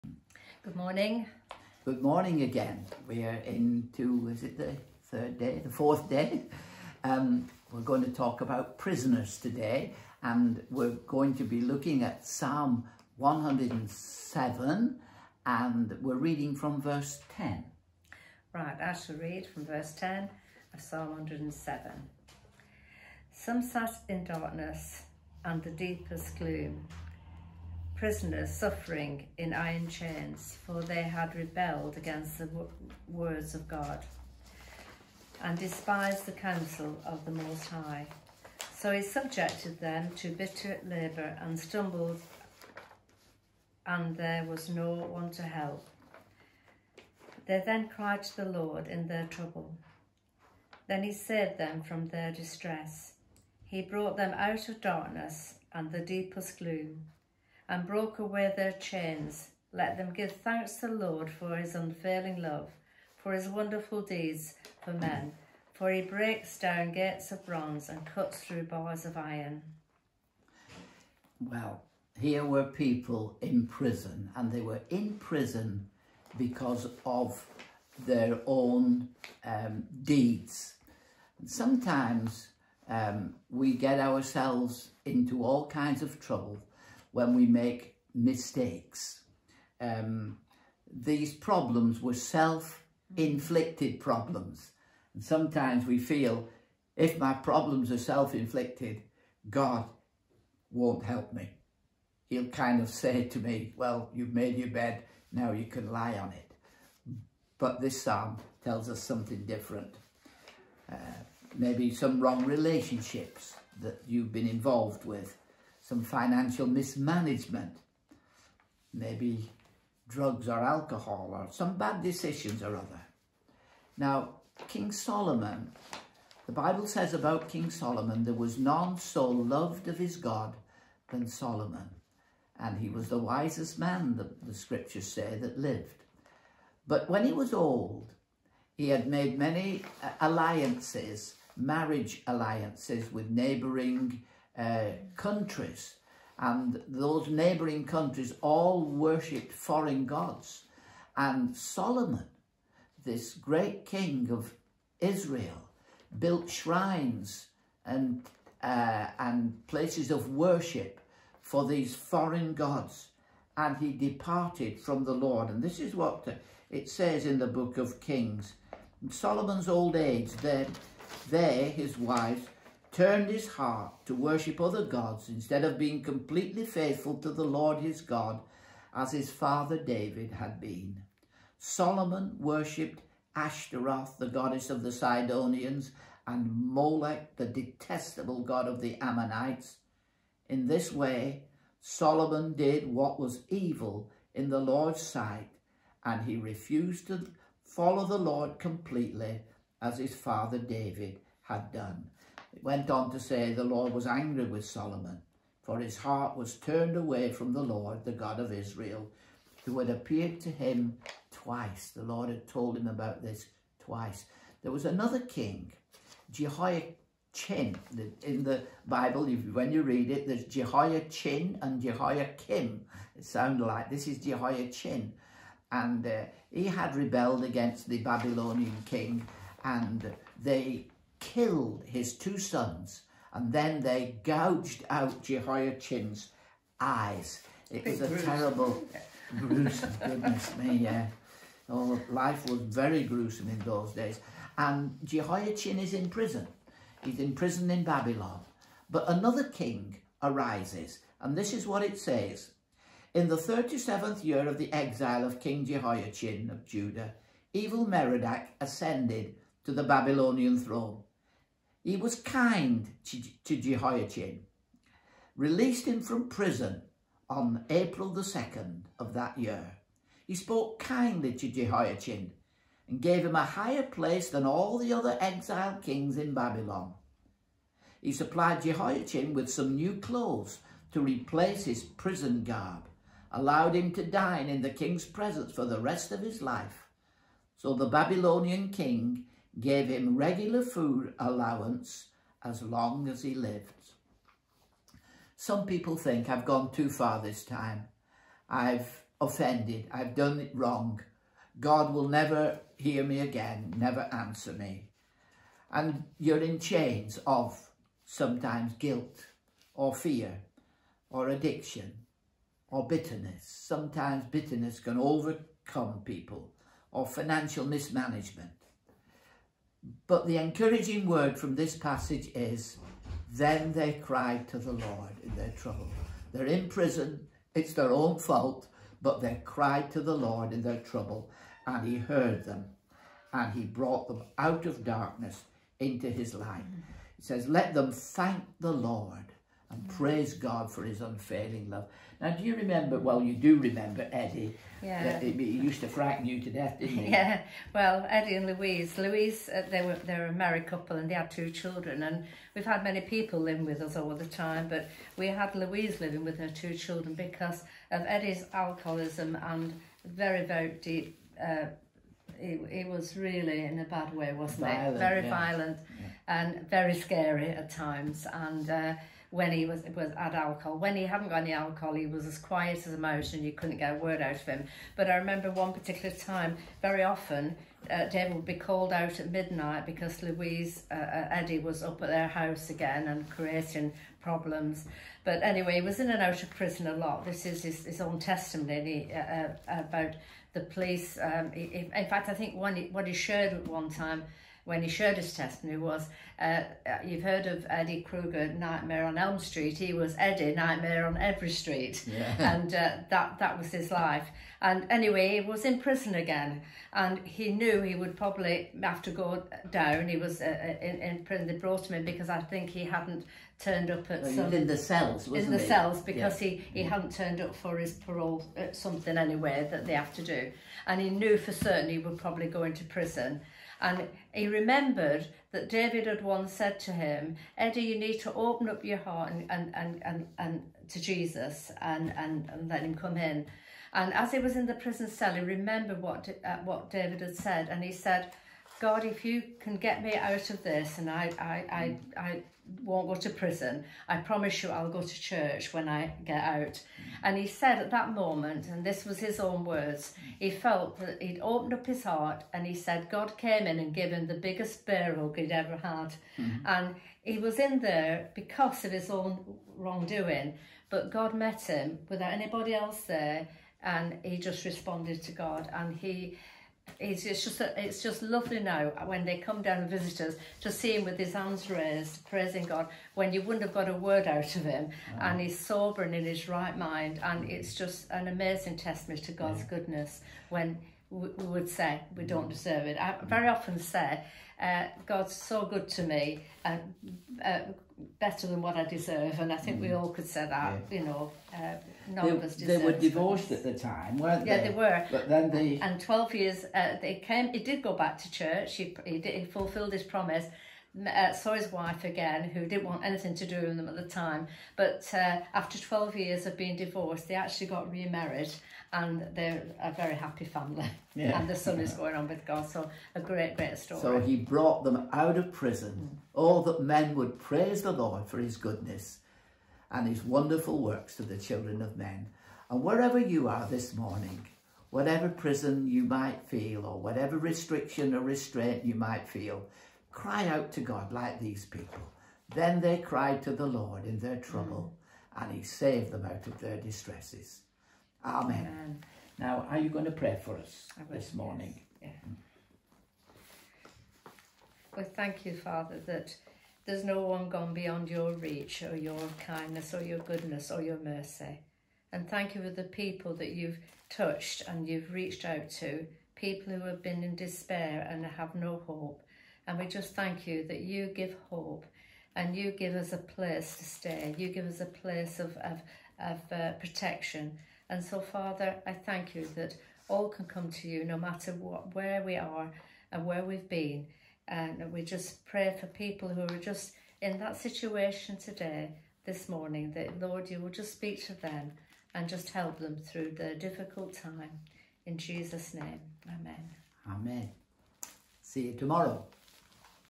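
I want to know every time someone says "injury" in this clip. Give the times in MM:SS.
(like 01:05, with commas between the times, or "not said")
not said.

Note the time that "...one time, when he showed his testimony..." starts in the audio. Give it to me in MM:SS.
06:33.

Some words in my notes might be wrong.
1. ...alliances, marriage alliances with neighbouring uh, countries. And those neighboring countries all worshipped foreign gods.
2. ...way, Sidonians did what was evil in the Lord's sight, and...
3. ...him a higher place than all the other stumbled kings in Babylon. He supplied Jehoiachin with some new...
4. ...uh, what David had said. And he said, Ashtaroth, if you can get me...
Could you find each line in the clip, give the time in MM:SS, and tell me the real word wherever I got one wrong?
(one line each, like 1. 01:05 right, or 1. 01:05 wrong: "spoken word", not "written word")
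1. 02:20 right
2. 03:10 wrong: "Solomon", not "Sidonians"
3. 04:33 wrong: "exiled", not "stumbled"
4. 07:16 wrong: "God", not "Ashtaroth".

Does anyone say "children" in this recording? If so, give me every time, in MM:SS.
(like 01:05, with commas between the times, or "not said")
05:51, 05:56, 08:41.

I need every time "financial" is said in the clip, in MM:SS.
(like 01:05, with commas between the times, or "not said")
01:56, 05:17.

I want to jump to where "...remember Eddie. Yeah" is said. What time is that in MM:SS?
05:43.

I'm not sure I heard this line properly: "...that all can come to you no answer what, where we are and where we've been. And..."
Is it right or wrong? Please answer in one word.
wrong.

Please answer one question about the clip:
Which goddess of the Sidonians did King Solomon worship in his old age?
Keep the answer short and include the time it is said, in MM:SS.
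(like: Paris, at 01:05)
Ashtaroth, at 03:03.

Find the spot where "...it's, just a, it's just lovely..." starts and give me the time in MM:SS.
07:46.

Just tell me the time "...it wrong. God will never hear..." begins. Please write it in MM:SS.
05:00.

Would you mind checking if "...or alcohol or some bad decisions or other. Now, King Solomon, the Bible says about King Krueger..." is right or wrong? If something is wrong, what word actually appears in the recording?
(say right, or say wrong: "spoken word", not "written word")
wrong: "Solomon", not "Krueger".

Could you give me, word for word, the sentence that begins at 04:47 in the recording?
So the Babylonian king gave him regular food allowance as long as he lived.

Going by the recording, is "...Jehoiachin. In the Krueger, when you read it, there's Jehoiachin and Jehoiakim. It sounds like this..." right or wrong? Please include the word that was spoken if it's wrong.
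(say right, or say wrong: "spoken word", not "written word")
wrong: "Bible", not "Krueger".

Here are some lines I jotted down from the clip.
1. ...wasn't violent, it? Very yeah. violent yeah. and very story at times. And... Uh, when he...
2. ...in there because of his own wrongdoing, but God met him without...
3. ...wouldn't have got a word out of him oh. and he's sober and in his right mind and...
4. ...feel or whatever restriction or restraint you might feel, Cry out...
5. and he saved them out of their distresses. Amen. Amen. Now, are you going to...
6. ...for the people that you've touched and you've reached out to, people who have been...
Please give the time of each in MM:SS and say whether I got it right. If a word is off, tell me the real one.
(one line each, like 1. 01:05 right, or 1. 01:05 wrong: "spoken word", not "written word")
1. 06:04 wrong: "scary", not "story"
2. 07:37 right
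3. 07:53 right
4. 08:46 right
5. 08:55 right
6. 09:12 right.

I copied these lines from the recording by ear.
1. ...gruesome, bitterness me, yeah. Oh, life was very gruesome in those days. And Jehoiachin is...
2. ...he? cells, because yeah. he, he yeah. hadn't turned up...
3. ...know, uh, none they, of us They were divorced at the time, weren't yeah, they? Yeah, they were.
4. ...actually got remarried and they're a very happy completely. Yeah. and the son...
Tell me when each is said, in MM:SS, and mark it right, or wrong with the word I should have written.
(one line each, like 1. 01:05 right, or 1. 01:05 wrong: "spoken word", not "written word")
1. 03:59 wrong: "goodness", not "bitterness"
2. 06:55 right
3. 08:11 right
4. 08:27 wrong: "family", not "completely".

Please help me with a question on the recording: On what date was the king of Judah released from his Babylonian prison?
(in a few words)
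April 2nd.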